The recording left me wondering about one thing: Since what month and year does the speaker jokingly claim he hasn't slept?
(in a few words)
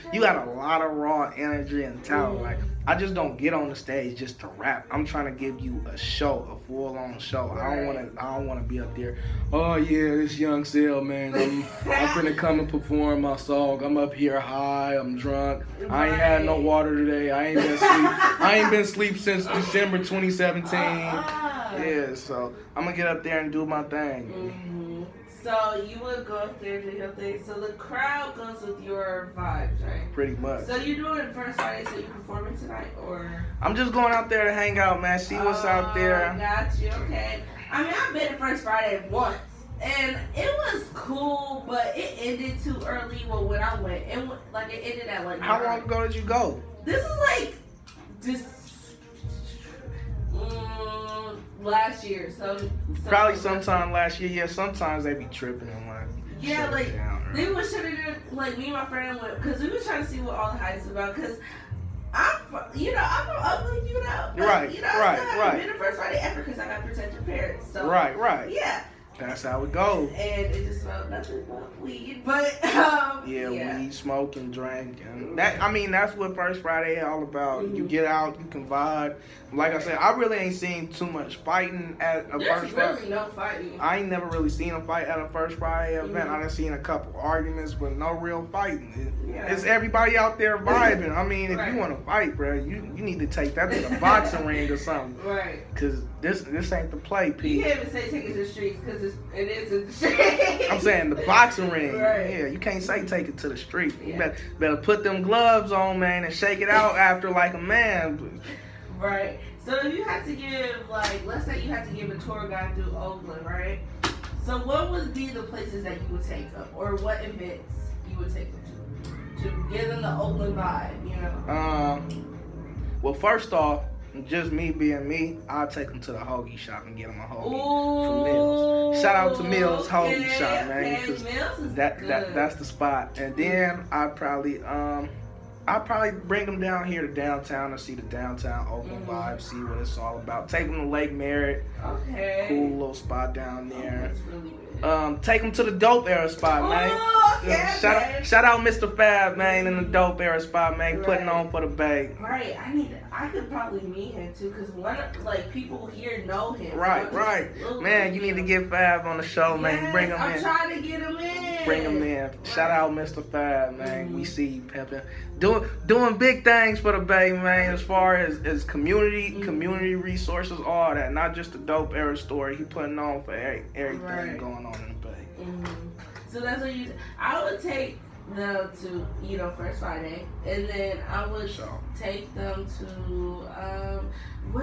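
December 2017.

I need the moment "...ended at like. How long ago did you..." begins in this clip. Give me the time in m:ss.
0:44.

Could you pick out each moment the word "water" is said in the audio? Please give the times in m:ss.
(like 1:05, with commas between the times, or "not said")
0:16.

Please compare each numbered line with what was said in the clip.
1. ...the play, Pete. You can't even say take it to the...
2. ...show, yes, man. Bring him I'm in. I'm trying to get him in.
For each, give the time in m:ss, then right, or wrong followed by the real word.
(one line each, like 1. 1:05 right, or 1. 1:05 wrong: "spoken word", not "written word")
1. 1:36 right
2. 2:39 right.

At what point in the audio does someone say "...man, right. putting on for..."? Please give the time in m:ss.
2:30.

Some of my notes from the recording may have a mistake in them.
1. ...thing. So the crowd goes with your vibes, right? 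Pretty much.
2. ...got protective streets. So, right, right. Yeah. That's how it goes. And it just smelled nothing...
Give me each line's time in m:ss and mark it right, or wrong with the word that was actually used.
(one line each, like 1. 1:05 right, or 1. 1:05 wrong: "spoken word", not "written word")
1. 0:27 right
2. 1:06 wrong: "parents", not "streets".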